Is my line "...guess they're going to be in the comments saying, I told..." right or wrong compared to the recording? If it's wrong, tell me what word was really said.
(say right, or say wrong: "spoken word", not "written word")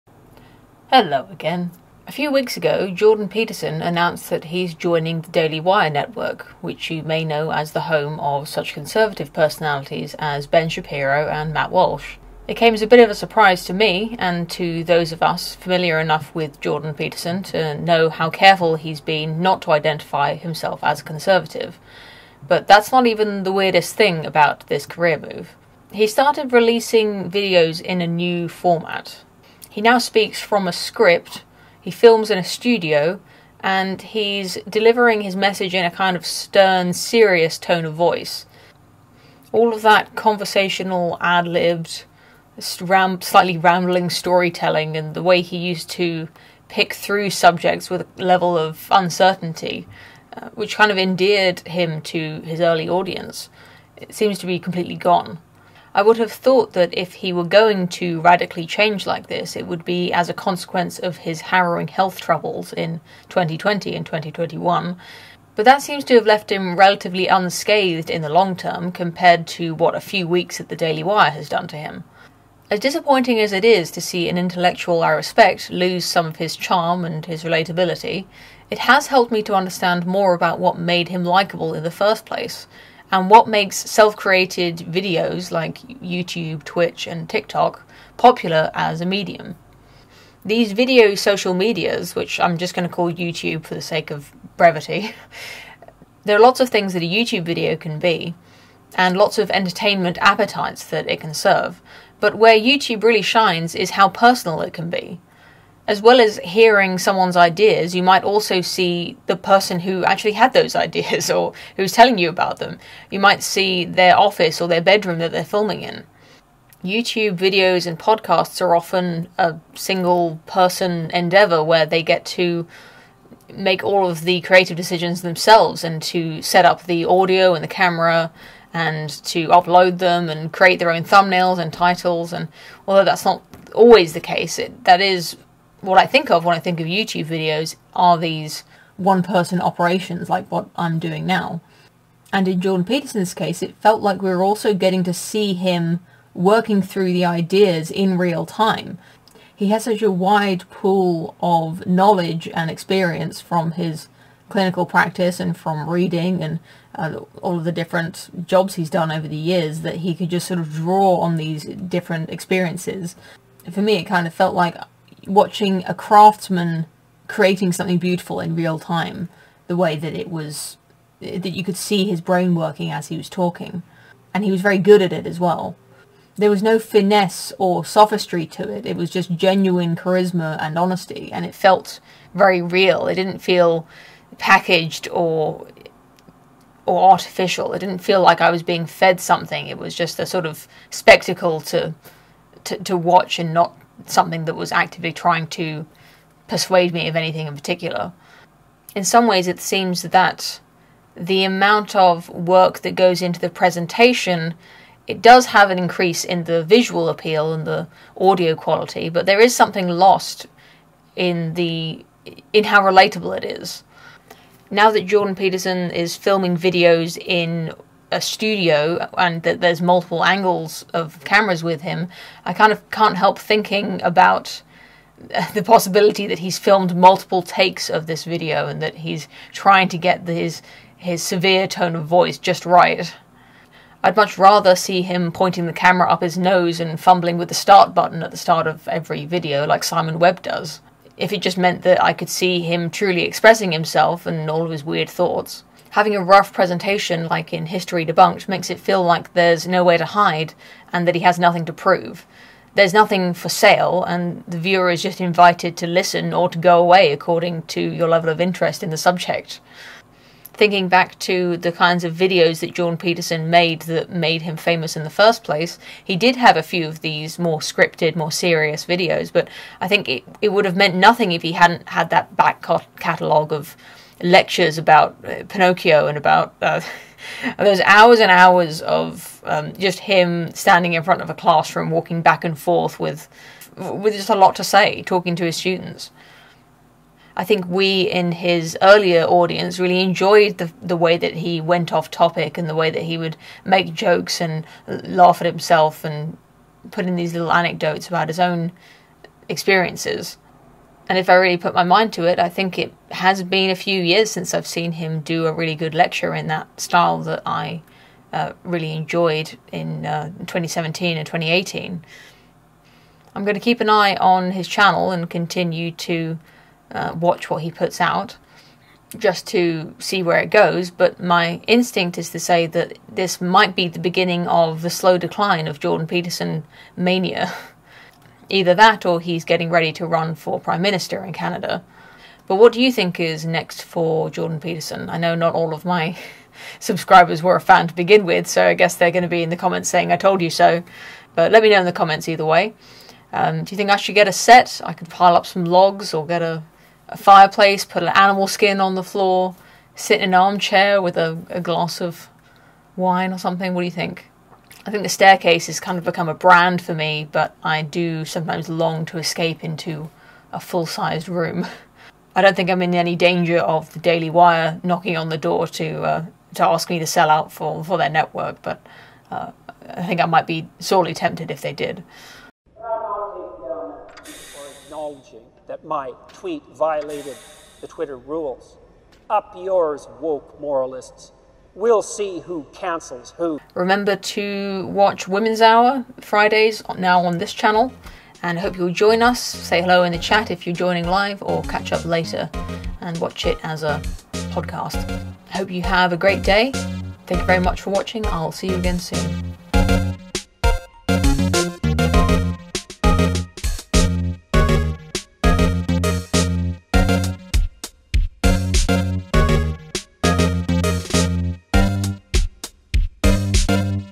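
right.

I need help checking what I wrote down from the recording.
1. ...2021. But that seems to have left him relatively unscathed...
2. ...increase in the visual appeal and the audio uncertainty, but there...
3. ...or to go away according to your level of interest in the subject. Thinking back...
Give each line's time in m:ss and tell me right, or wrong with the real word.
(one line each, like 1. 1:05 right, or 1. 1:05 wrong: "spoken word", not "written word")
1. 1:04 right
2. 3:25 wrong: "quality", not "uncertainty"
3. 4:16 right.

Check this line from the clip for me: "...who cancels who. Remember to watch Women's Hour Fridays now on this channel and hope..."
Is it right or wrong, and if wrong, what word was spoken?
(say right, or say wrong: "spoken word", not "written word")
right.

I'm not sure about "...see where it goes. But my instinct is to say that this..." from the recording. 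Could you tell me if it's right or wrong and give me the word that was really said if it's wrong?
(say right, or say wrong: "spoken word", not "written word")
right.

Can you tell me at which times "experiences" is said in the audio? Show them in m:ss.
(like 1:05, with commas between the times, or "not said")
2:32, 2:42, 4:59.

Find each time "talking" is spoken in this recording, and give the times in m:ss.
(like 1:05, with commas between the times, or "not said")
2:53, 4:45.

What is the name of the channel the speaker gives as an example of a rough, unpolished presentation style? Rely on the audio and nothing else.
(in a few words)
History Debunked.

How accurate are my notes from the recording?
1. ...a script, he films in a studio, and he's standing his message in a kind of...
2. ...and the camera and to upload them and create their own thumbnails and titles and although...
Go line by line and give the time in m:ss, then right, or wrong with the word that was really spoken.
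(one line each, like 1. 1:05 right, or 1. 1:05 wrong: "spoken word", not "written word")
1. 0:30 wrong: "delivering", not "standing"
2. 2:07 right.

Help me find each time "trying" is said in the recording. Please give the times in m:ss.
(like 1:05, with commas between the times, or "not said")
3:15, 3:49.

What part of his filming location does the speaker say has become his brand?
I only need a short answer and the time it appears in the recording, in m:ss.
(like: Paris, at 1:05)
the staircase, at 5:55.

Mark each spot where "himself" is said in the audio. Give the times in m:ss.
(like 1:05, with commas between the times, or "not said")
0:20, 4:03, 4:55.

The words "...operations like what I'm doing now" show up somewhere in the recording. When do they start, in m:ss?
2:19.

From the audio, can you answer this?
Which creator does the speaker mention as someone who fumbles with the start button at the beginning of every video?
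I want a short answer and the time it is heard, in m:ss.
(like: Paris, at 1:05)
Simon Webb, at 3:59.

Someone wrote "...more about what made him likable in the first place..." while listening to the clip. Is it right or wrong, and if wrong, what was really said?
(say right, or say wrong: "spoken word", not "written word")
right.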